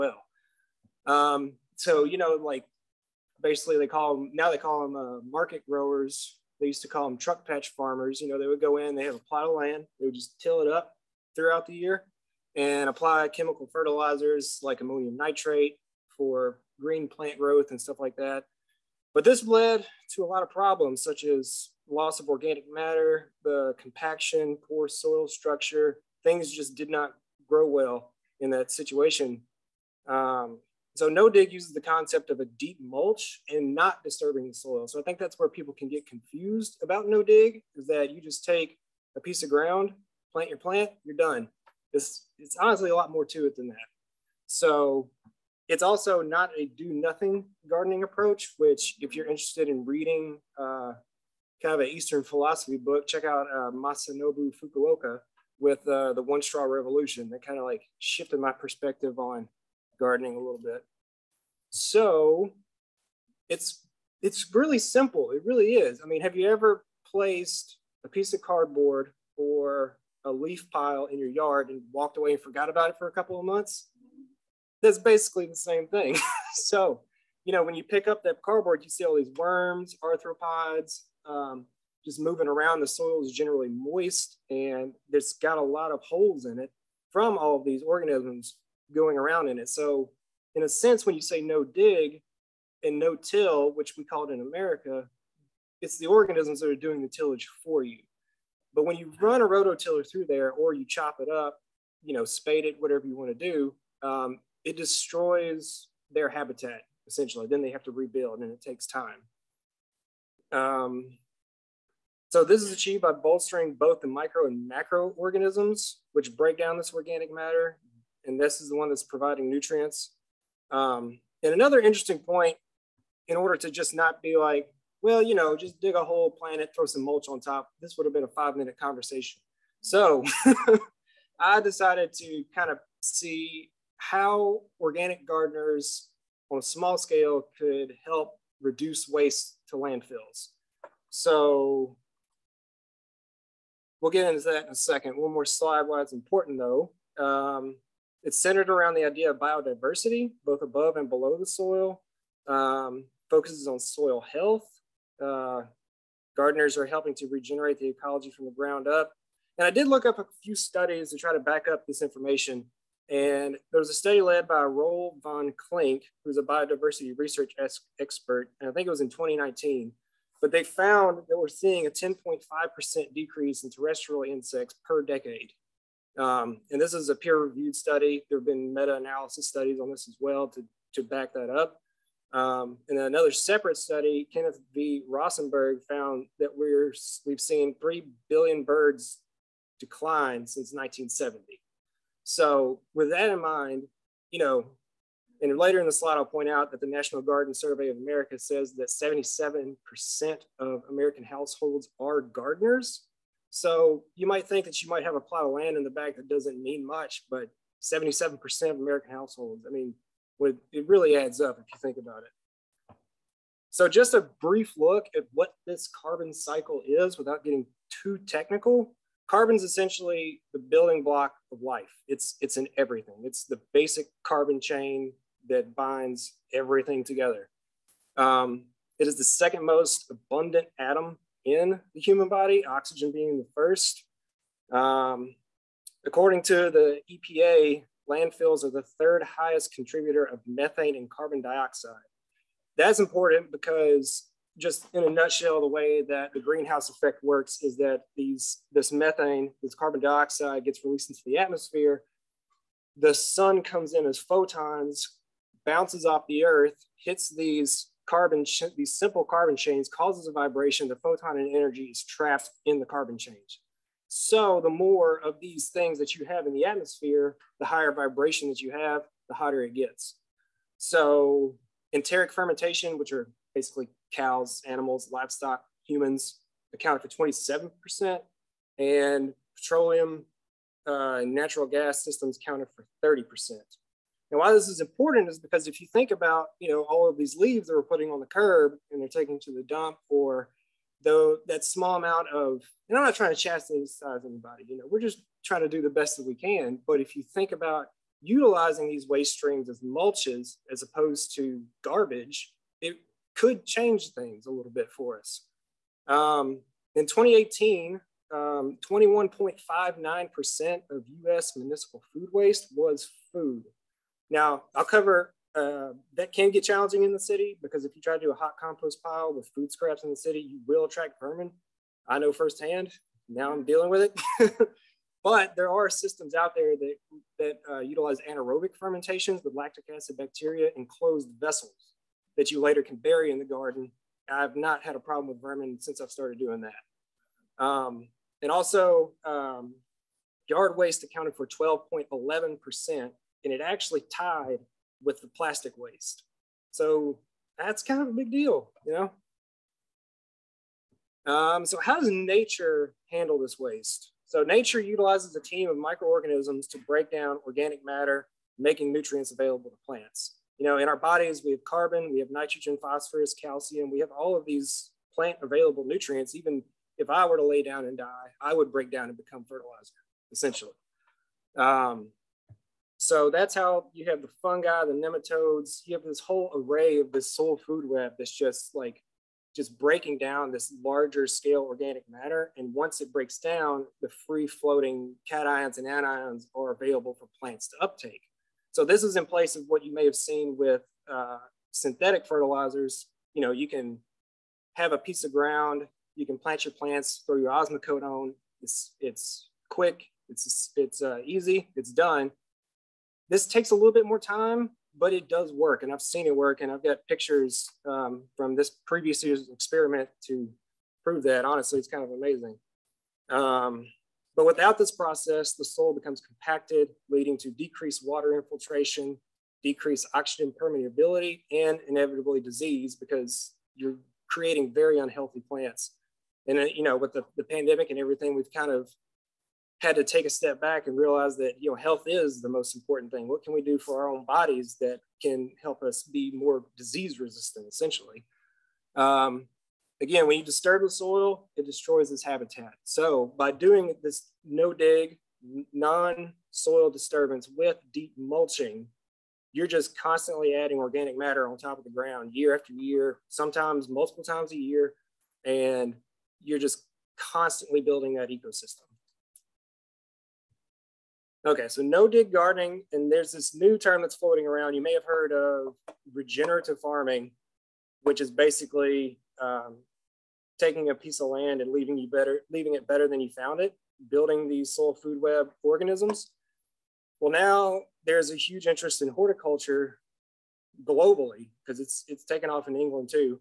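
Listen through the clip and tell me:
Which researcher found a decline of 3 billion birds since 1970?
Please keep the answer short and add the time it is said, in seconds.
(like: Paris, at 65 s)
Kenneth V. Rosenberg, at 184 s.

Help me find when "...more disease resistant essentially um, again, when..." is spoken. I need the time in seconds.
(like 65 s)
436 s.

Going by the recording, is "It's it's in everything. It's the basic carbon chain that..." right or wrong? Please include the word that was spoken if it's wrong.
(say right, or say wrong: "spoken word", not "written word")
right.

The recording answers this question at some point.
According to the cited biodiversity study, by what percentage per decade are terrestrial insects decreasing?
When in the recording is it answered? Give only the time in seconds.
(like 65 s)
171 s.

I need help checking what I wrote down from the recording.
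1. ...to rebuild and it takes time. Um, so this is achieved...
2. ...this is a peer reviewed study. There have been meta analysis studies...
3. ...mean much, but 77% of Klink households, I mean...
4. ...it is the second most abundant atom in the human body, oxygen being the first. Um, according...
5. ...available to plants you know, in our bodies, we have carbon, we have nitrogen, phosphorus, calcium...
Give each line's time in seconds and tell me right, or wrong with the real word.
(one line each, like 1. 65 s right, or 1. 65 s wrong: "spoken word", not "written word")
1. 107 s right
2. 176 s right
3. 206 s wrong: "American", not "Klink"
4. 228 s right
5. 359 s right.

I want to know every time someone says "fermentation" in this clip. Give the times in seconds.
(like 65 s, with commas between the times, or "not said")
272 s, 328 s.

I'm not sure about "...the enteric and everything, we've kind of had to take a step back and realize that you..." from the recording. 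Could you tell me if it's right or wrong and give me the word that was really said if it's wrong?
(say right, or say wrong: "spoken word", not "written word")
wrong: "pandemic", not "enteric".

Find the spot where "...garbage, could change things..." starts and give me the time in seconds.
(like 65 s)
301 s.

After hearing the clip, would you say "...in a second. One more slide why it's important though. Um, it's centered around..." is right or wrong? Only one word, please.
right.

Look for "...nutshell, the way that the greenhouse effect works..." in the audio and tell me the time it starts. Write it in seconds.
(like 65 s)
245 s.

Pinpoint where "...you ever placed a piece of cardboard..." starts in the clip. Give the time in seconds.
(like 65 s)
66 s.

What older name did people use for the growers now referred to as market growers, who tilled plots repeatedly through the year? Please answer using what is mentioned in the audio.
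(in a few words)
truck patch farmers.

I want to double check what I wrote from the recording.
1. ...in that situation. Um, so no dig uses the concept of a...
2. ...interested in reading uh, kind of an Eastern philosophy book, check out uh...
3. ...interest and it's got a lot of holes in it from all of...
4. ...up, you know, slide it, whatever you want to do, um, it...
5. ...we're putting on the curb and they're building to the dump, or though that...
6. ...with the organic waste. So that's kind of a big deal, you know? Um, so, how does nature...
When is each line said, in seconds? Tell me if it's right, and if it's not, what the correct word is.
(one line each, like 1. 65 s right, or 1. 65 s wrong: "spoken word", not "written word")
1. 28 s right
2. 49 s right
3. 83 s wrong: "moist", not "interest"
4. 101 s wrong: "spade", not "slide"
5. 287 s wrong: "taking", not "building"
6. 345 s wrong: "plastic", not "organic".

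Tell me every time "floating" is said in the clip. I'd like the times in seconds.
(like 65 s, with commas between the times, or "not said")
384 s, 464 s.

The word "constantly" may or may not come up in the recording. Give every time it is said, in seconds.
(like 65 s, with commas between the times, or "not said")
449 s, 457 s.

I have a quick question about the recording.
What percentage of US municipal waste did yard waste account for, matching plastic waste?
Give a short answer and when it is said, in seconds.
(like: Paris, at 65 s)
12.11%, at 341 s.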